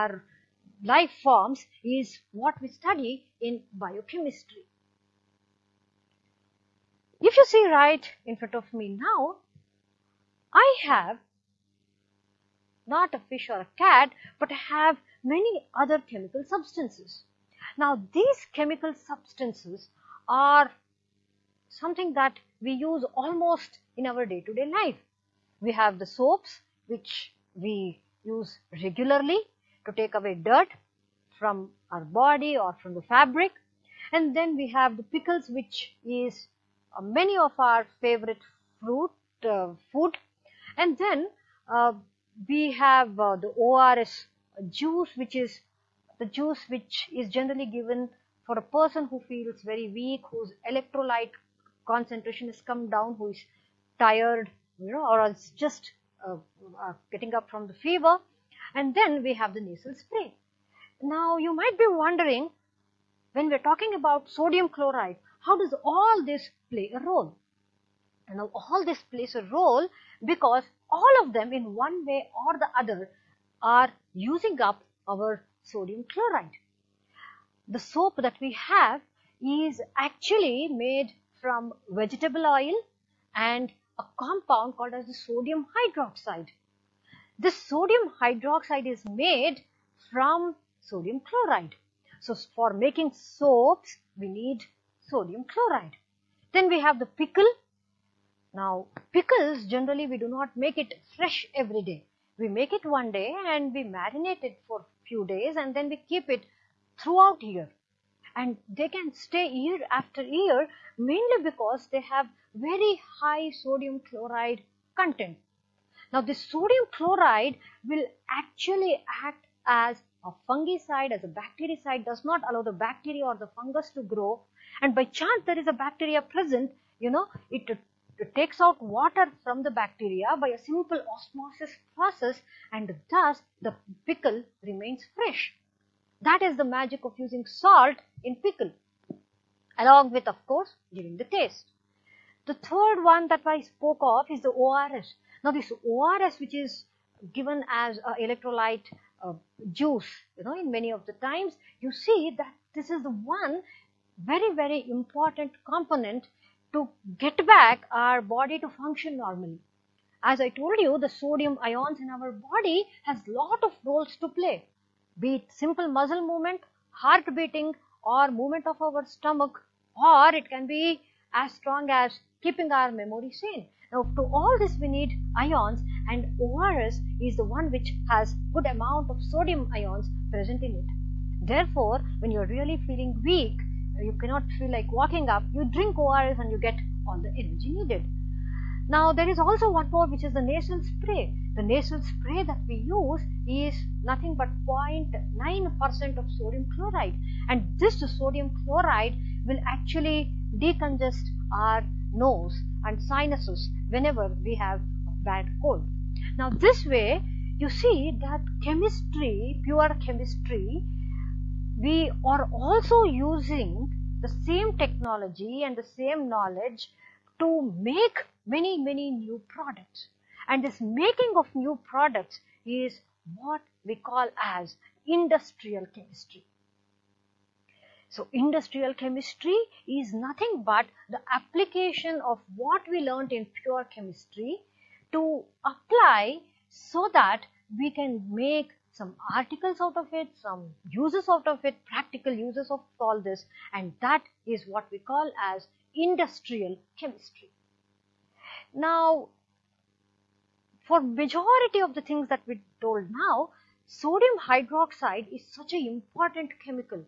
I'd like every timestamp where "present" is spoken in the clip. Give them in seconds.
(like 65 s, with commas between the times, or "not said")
126 s, 180 s.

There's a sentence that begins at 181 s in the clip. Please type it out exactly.
Therefore, when you're really feeling weak, you cannot feel like walking up, you drink ORS and you get all the energy needed.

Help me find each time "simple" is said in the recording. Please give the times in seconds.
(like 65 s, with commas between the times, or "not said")
130 s, 165 s.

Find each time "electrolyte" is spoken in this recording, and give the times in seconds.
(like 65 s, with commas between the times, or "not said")
50 s, 148 s.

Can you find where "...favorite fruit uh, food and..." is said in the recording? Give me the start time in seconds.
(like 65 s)
38 s.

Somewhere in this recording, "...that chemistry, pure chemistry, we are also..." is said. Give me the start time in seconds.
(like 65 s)
208 s.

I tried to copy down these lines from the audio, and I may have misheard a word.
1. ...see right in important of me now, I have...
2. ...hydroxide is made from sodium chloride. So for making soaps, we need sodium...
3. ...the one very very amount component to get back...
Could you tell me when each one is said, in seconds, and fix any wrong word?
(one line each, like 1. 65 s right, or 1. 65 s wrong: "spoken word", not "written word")
1. 7 s wrong: "front", not "important"
2. 88 s right
3. 153 s wrong: "important", not "amount".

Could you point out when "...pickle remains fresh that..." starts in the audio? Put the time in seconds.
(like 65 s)
134 s.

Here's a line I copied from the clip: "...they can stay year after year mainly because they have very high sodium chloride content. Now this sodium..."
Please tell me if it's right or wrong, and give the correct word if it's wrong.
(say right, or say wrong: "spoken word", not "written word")
right.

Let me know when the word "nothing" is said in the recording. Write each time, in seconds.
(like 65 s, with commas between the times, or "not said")
194 s, 230 s.